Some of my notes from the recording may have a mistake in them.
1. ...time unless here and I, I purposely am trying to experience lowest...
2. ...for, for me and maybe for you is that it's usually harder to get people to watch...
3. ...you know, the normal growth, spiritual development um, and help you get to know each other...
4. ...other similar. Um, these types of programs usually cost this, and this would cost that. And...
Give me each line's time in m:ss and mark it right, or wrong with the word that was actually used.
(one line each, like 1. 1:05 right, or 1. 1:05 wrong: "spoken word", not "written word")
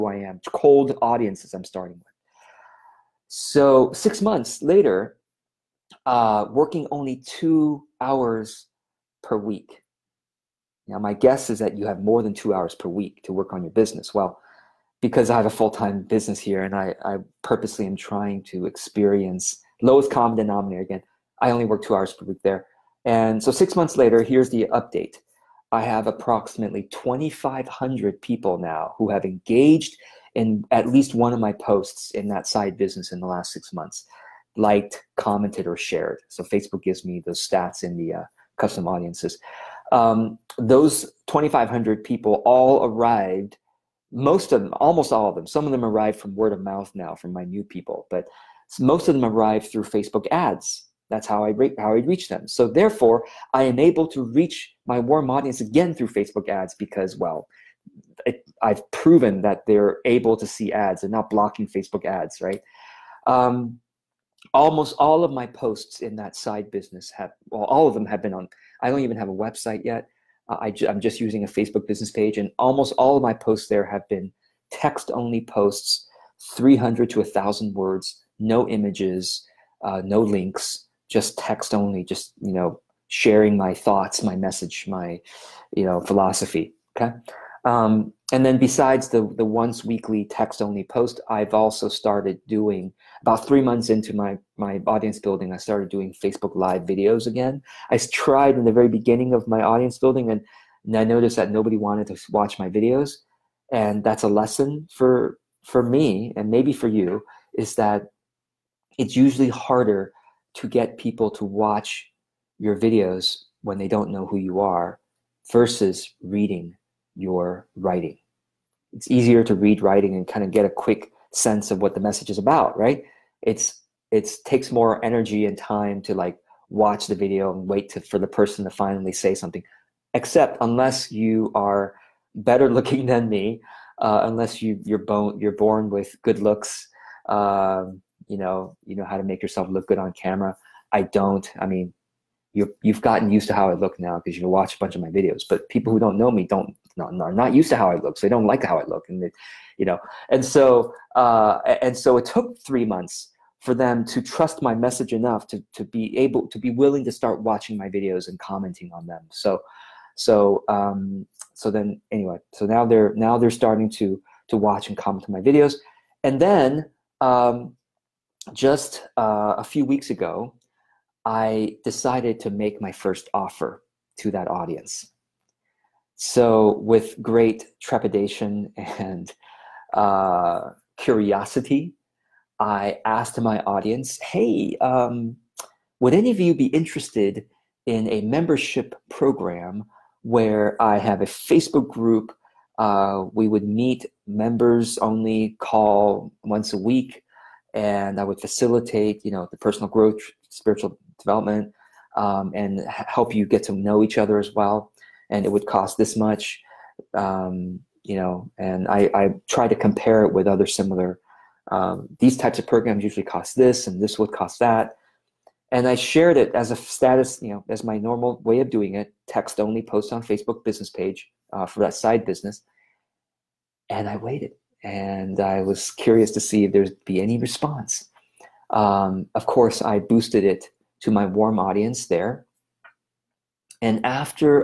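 1. 0:15 wrong: "business", not "unless"
2. 1:44 right
3. 3:19 wrong: "personal", not "normal"
4. 3:30 right.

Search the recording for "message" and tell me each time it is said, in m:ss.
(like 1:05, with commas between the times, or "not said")
1:24, 2:02, 2:34.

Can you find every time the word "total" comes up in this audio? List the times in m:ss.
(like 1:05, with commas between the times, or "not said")
not said.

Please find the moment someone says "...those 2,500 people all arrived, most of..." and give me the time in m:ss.
0:40.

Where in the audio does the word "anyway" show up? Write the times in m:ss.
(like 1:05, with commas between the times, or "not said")
2:42.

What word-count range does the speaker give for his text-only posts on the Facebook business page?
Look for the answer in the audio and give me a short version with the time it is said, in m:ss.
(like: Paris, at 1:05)
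300 to 1000 words, at 1:16.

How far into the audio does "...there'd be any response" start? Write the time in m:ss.
3:46.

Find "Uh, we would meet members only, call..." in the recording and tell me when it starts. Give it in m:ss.
3:12.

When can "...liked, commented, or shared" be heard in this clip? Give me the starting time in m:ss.
0:34.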